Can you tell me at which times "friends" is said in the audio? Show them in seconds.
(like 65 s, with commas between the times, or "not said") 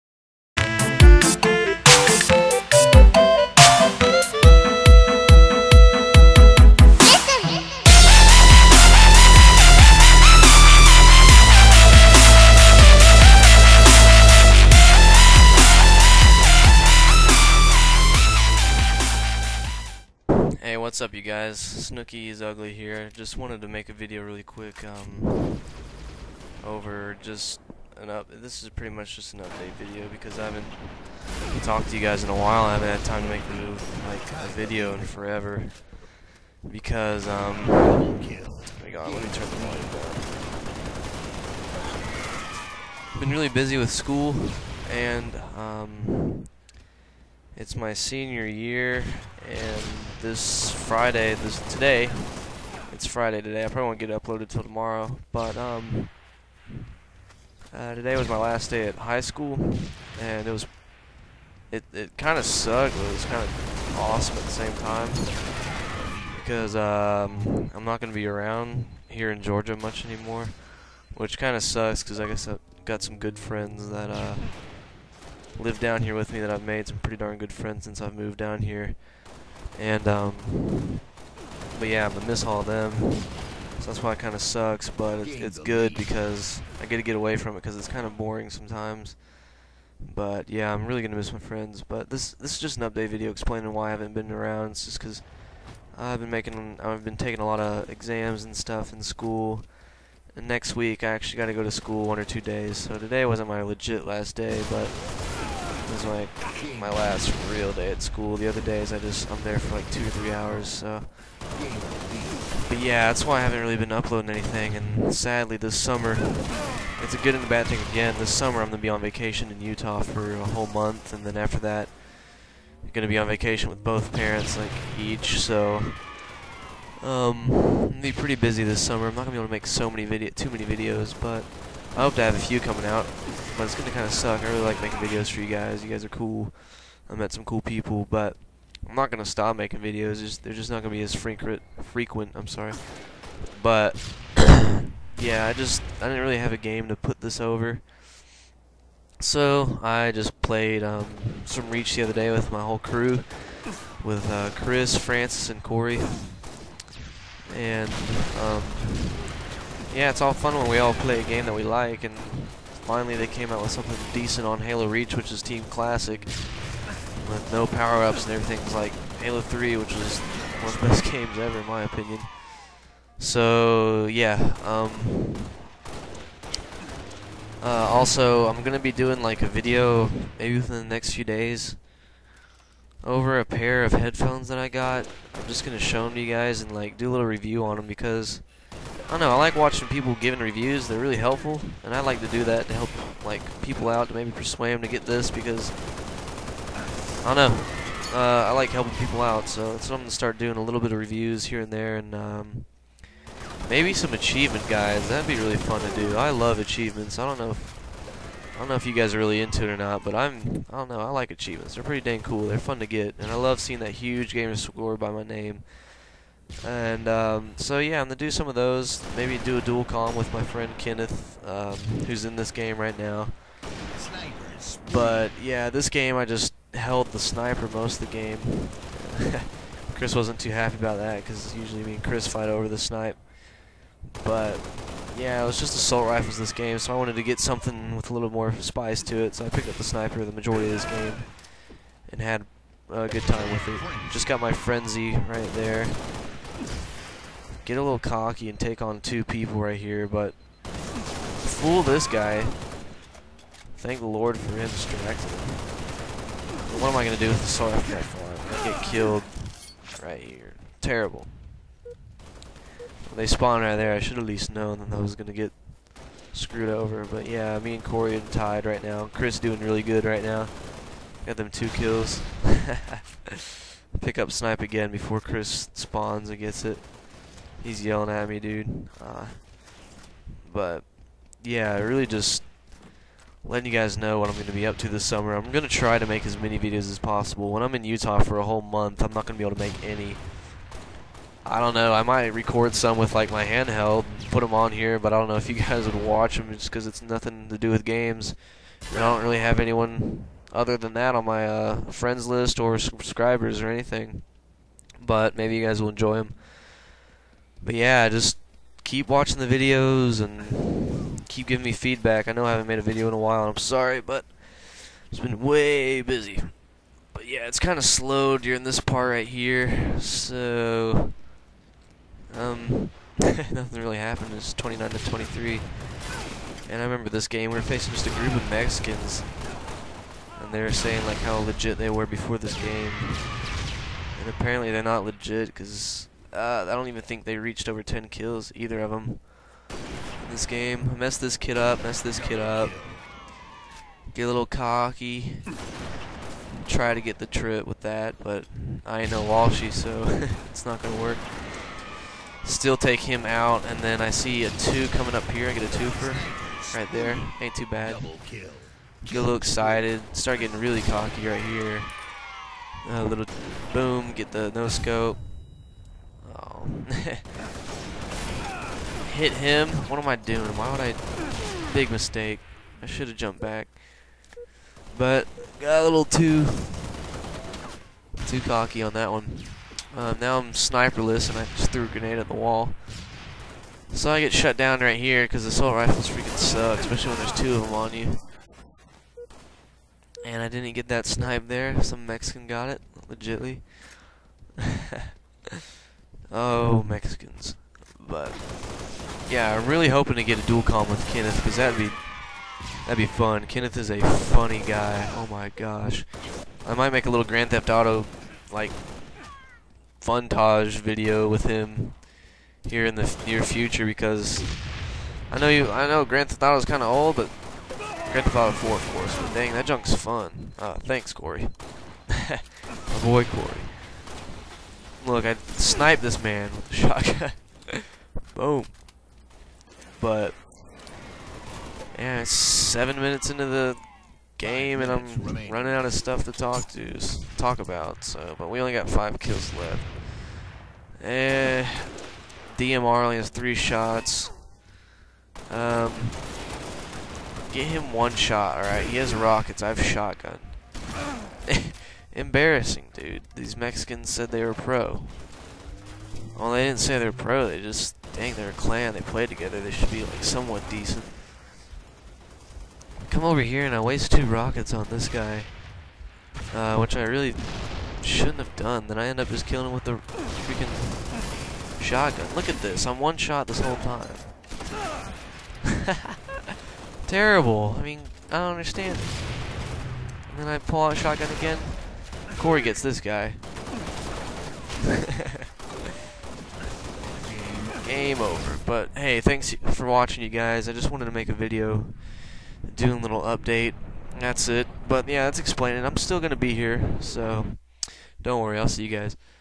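73 s, 77 s, 91 s, 220 s, 301 s.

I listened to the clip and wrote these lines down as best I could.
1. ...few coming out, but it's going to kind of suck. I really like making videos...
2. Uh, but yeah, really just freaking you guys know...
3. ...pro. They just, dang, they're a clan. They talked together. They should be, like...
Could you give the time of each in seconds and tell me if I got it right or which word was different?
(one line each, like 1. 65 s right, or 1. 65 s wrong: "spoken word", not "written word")
1. 132 s right
2. 279 s wrong: "letting", not "freaking"
3. 457 s wrong: "played", not "talked".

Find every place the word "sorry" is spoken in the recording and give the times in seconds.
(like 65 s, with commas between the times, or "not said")
142 s, 313 s.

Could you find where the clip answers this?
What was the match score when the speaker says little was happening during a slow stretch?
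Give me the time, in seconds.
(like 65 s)
324 s.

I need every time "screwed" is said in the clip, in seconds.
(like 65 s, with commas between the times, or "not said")
266 s.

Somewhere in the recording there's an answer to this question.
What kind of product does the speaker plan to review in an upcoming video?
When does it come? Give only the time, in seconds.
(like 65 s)
183 s.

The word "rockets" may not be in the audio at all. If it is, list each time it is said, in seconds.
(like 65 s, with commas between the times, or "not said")
449 s, 464 s.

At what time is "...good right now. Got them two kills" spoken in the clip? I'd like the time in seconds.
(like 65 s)
269 s.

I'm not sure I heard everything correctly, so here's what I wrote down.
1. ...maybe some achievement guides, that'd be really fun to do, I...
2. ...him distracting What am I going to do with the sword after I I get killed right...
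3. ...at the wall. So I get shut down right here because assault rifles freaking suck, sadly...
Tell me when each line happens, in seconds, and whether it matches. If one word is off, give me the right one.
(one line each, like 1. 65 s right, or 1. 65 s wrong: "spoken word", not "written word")
1. 203 s right
2. 254 s right
3. 382 s wrong: "especially", not "sadly".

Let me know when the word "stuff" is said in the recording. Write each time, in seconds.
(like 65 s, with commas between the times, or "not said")
98 s, 435 s.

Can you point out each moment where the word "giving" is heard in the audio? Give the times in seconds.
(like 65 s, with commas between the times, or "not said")
190 s, 311 s.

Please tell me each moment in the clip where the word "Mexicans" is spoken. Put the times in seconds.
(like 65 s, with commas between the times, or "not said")
328 s, 392 s, 396 s, 453 s.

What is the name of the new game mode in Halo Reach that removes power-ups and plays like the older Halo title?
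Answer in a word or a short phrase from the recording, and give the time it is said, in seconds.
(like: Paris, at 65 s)
Team Classic, at 165 s.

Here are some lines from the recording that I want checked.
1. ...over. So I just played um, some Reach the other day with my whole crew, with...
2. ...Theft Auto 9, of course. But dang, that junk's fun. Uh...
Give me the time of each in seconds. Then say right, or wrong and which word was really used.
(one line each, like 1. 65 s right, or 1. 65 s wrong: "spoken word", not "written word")
1. 147 s right
2. 418 s wrong: "4", not "9".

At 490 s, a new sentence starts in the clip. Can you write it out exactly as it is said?
I just wanted to make a video, doing a little update.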